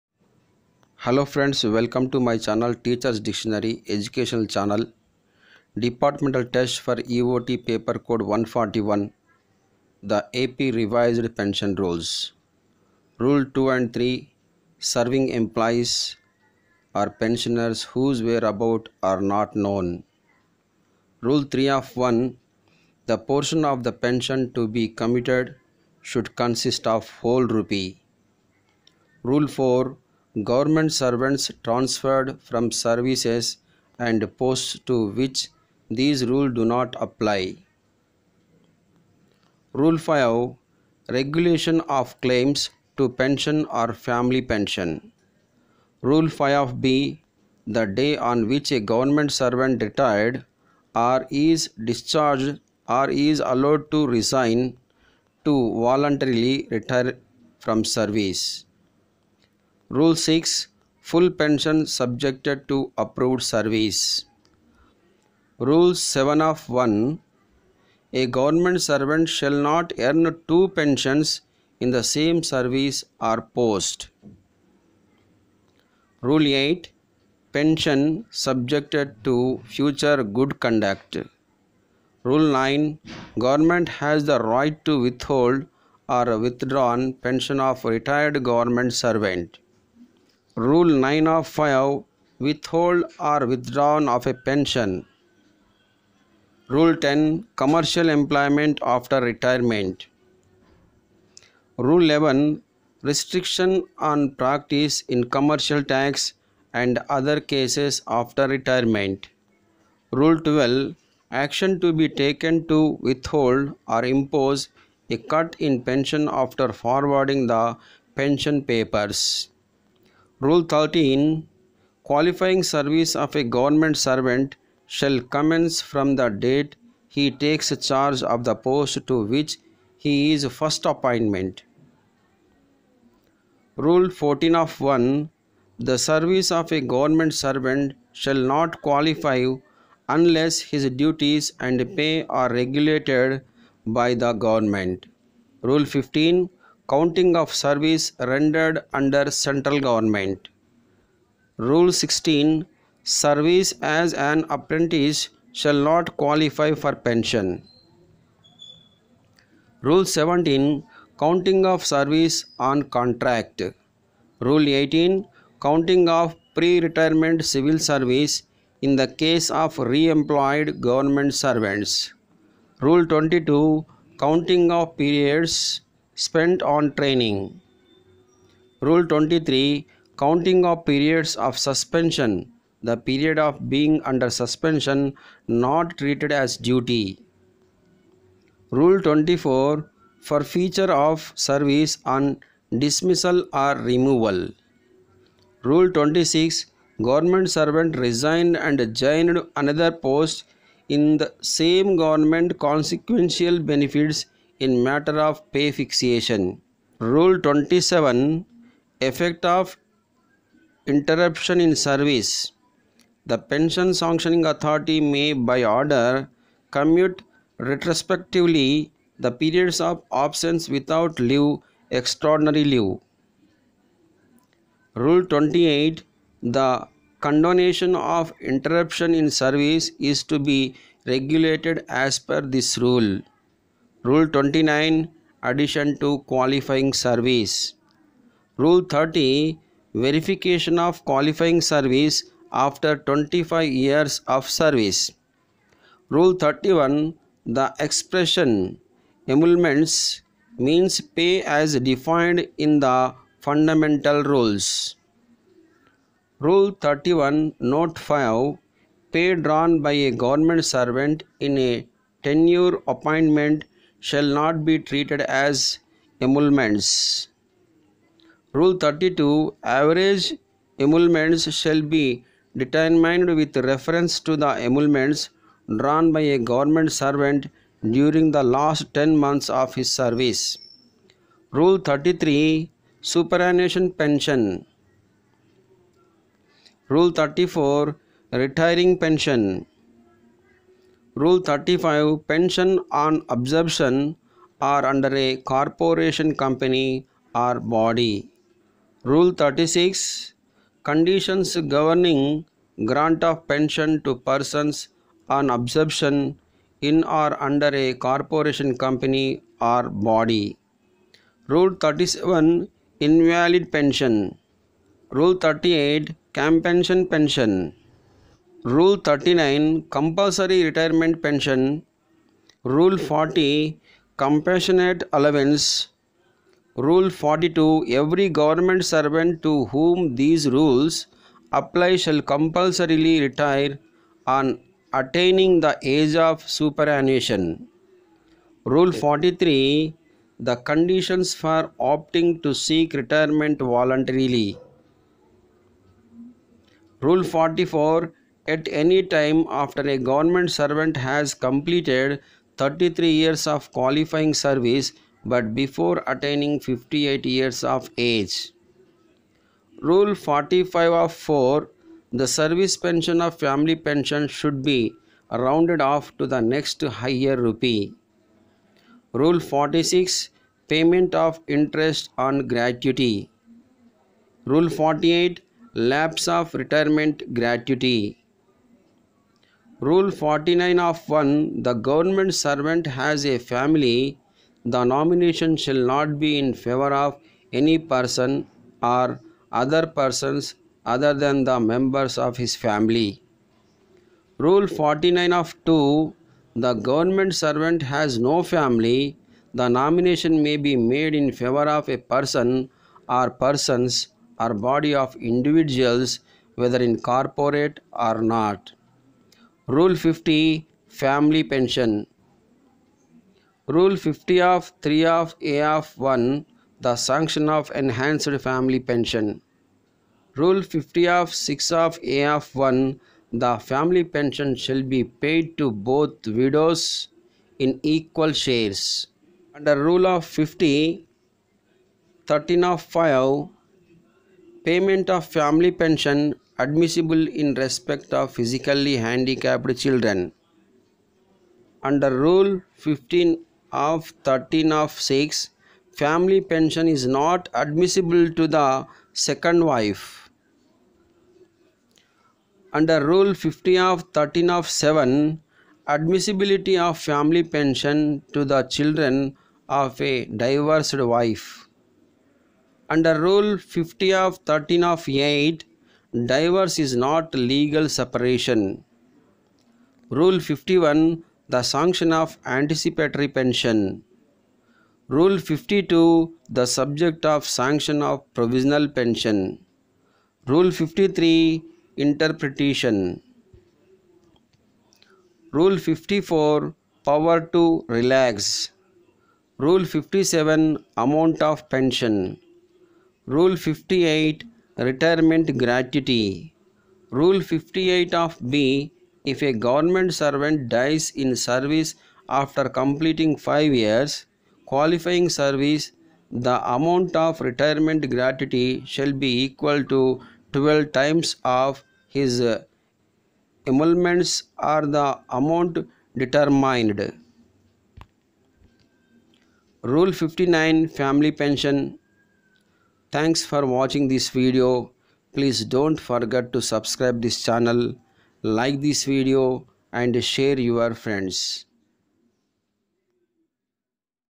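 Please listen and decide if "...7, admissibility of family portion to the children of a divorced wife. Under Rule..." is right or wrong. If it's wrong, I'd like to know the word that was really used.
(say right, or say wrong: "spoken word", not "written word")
wrong: "pension", not "portion".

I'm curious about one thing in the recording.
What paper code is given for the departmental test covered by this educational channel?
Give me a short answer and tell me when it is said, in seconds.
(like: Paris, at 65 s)
141, at 8 s.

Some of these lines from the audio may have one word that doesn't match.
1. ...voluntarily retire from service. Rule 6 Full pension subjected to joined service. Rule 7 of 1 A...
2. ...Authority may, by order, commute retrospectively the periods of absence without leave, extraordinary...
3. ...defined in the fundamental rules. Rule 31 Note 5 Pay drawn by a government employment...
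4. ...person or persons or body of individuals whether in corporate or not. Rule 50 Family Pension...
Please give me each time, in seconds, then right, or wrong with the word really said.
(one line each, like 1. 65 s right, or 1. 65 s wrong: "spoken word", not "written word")
1. 55 s wrong: "approved", not "joined"
2. 214 s right
3. 251 s wrong: "servant", not "employment"
4. 401 s right.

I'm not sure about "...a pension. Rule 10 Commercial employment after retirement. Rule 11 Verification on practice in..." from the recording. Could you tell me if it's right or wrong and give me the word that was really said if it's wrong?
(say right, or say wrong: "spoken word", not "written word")
wrong: "Restriction", not "Verification".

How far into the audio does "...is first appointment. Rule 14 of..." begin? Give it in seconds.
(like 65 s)
130 s.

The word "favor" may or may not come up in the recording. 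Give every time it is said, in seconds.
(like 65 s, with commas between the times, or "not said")
386 s, 401 s.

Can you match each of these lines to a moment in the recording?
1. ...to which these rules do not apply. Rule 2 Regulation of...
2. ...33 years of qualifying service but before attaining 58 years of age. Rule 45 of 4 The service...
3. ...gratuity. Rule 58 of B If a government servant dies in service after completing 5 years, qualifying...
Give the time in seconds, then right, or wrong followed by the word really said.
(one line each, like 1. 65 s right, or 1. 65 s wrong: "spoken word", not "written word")
1. 34 s wrong: "5", not "2"
2. 352 s right
3. 495 s right.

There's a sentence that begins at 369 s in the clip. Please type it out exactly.
Rule 46 Payment of interest on gratuity.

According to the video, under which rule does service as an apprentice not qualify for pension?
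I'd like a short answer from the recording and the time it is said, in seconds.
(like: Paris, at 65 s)
Rule 16, at 151 s.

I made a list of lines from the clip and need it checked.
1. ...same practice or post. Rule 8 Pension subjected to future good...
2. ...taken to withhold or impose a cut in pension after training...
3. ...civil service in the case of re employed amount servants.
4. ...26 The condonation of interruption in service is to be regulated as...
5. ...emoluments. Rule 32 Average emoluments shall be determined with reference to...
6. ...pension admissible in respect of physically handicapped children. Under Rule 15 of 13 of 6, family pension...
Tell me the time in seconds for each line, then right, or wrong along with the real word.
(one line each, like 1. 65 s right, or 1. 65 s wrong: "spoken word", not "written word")
1. 72 s wrong: "service", not "practice"
2. 112 s wrong: "forwarding", not "training"
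3. 167 s wrong: "government", not "amount"
4. 225 s wrong: "28", not "26"
5. 266 s right
6. 435 s right.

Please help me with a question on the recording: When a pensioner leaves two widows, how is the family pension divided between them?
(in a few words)
equal shares.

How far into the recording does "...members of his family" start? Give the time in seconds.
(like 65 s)
391 s.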